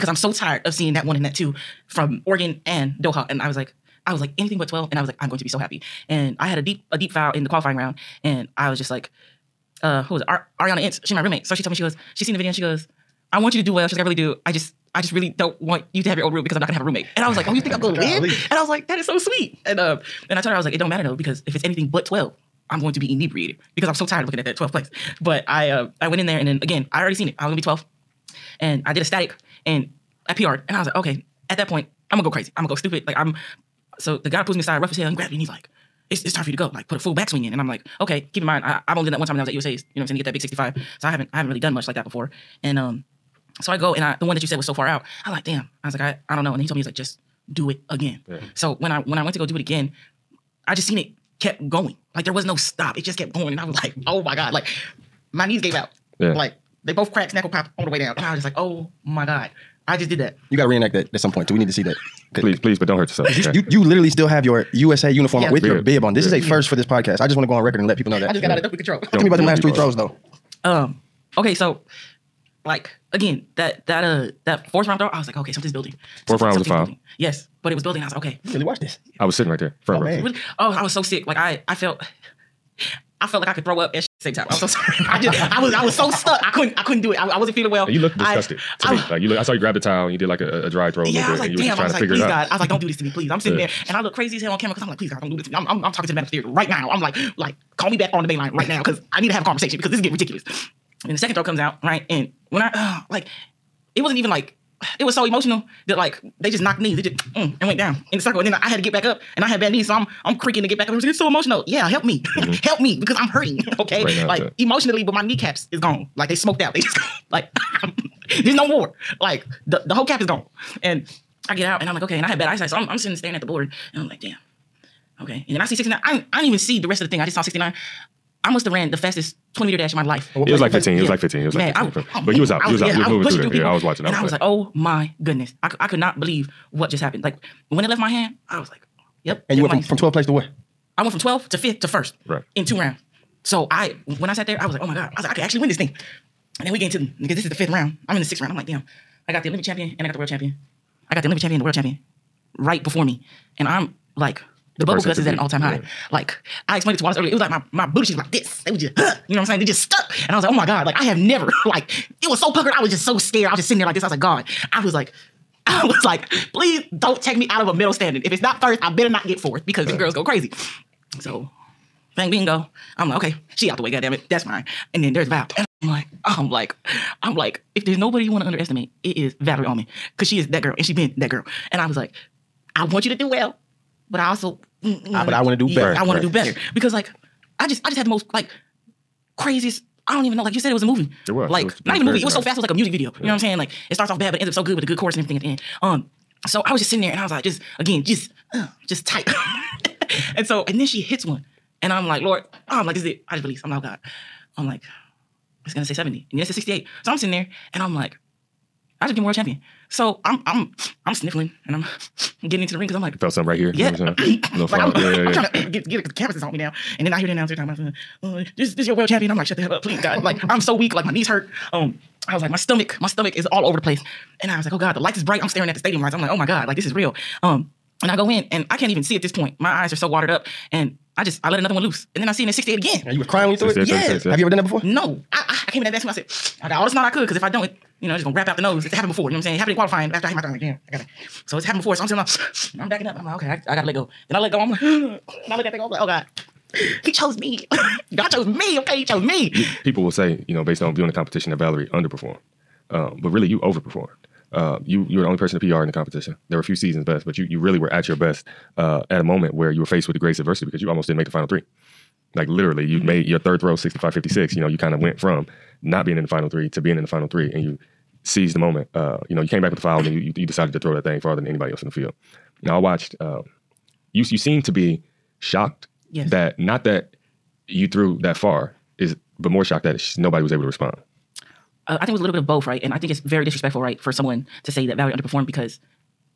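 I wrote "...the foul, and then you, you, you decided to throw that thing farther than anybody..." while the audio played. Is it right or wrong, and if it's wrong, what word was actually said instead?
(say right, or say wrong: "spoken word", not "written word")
right.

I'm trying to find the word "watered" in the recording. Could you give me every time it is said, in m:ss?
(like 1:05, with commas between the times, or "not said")
3:50.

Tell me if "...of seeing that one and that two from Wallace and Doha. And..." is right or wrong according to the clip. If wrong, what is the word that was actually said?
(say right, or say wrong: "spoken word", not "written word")
wrong: "Oregon", not "Wallace".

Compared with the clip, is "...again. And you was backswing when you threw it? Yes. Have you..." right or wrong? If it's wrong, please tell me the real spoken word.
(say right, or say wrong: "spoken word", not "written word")
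wrong: "crying", not "backswing".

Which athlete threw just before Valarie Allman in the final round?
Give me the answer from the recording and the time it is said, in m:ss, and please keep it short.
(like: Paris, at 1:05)
Feng Bin, at 2:52.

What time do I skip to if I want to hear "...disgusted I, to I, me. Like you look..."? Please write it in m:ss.
1:28.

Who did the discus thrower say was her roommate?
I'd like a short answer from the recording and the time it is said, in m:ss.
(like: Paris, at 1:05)
Ariana Ince, at 0:10.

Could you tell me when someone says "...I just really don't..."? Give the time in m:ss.
0:14.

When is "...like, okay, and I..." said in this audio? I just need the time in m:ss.
2:01.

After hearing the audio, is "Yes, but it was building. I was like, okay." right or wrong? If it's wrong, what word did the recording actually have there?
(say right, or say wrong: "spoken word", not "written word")
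right.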